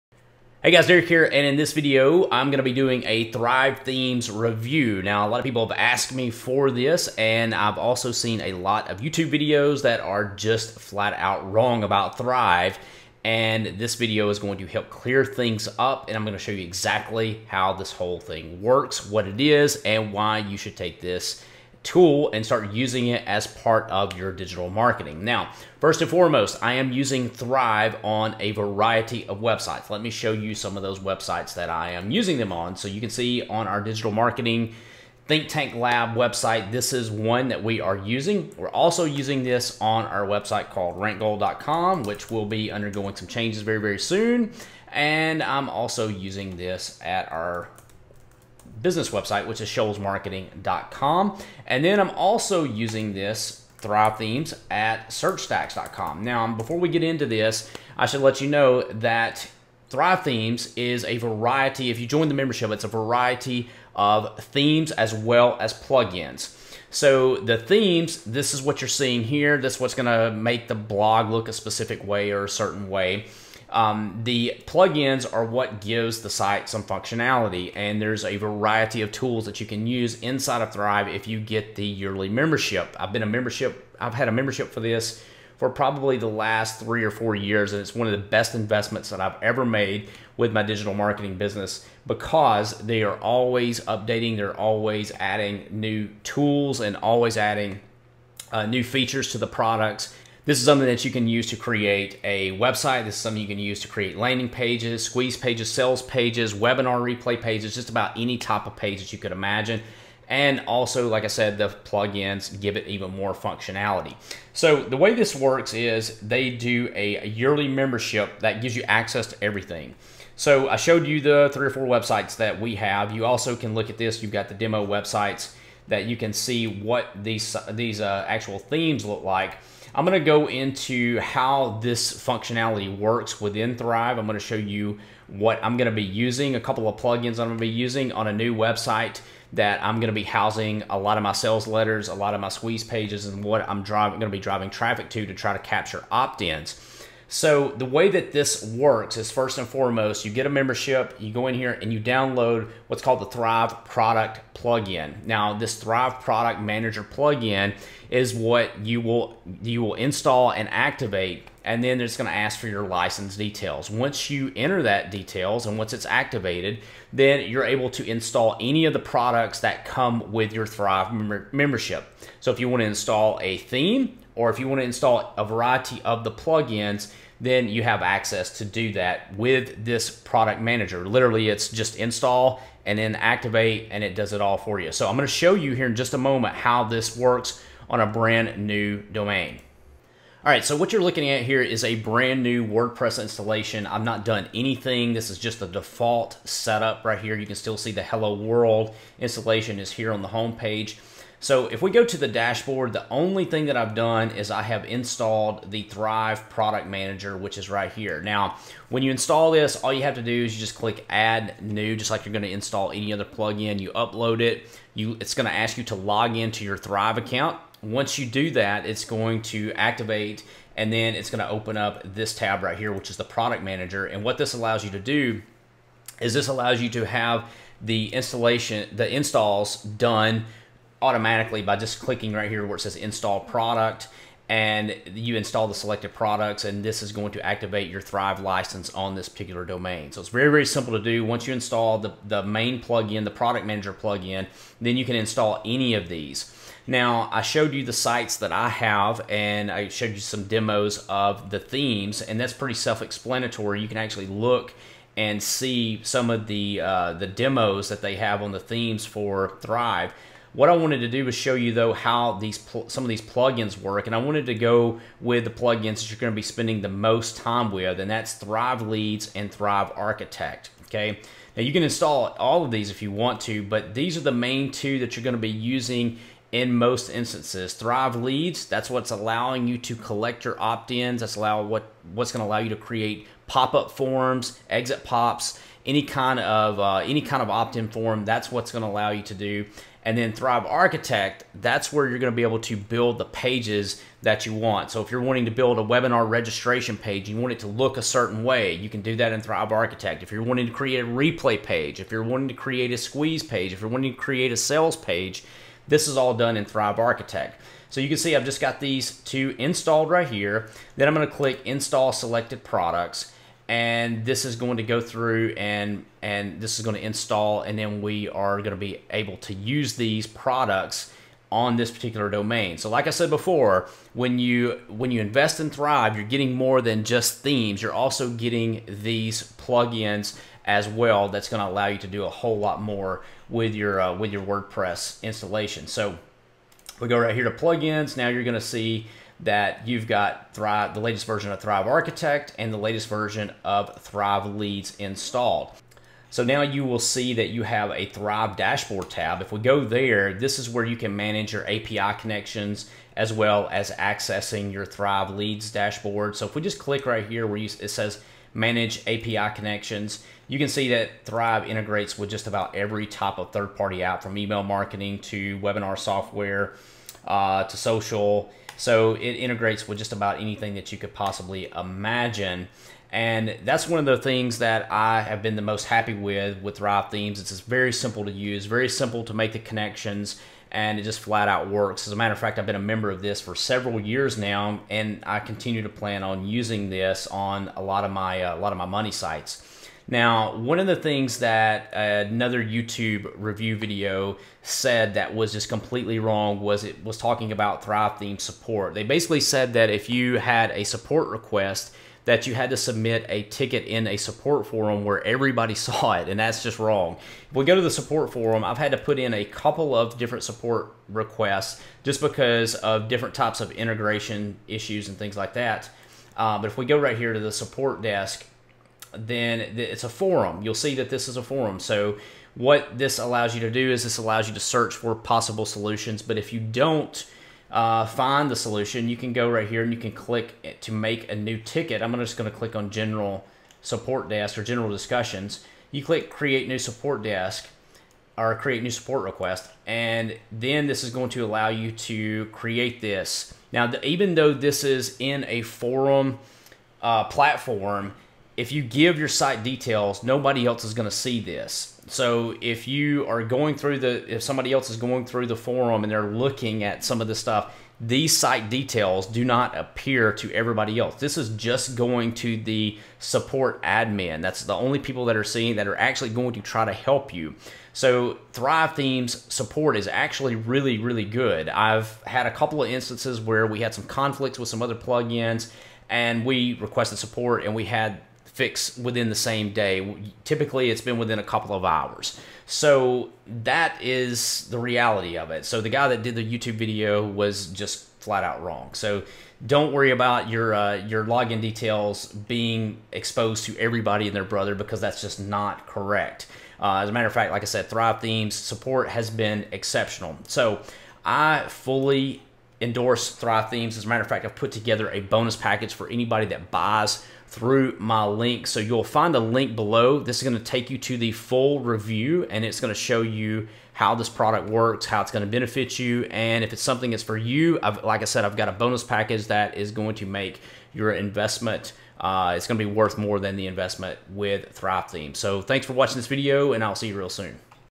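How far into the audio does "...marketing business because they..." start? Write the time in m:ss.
1:30.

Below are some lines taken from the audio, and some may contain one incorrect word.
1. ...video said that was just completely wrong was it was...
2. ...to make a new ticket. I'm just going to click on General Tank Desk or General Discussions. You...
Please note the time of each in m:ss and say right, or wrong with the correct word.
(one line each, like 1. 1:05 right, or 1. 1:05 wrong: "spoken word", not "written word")
1. 6:33 right
2. 7:10 wrong: "Support", not "Tank".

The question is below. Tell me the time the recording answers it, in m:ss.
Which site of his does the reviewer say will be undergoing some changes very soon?
0:40.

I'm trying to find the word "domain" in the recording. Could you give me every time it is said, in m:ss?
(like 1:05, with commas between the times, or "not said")
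3:09, 3:59, 5:22.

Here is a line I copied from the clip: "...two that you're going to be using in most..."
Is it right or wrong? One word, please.
right.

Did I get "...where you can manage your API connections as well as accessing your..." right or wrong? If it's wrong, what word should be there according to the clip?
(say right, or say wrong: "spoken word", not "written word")
right.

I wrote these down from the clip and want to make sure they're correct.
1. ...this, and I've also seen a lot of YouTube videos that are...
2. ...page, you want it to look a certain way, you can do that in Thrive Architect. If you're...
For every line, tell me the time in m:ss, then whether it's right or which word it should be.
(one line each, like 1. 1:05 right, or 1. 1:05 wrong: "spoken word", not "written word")
1. 0:06 right
2. 4:56 right.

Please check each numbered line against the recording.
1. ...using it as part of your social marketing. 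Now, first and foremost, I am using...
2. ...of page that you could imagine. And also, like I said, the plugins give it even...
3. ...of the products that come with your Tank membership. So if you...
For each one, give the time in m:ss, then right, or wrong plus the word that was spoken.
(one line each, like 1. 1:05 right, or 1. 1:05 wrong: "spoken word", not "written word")
1. 0:22 wrong: "digital", not "social"
2. 1:48 right
3. 2:48 wrong: "Thrive", not "Tank".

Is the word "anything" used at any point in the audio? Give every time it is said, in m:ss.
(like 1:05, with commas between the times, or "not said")
3:14, 6:10.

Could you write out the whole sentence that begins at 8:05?
So the guy that did the YouTube video was just flat out wrong.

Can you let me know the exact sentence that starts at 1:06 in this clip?
So the themes, this is what you're seeing here.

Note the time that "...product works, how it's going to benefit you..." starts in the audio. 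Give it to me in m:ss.
8:34.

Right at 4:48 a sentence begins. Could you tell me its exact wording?
That's what's going to allow you to do.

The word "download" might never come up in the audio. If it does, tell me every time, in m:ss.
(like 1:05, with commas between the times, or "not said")
2:32.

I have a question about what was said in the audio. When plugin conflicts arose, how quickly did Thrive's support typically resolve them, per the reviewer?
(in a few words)
within a couple of hours.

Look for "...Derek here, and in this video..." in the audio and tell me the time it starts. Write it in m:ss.
0:00.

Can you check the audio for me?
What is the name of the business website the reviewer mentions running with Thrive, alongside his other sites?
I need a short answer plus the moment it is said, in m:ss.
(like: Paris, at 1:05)
shoalsmarketing.com, at 0:49.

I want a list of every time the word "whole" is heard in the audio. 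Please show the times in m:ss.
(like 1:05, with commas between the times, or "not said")
0:17, 5:32.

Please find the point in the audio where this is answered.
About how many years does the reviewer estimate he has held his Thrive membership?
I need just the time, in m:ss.
1:26.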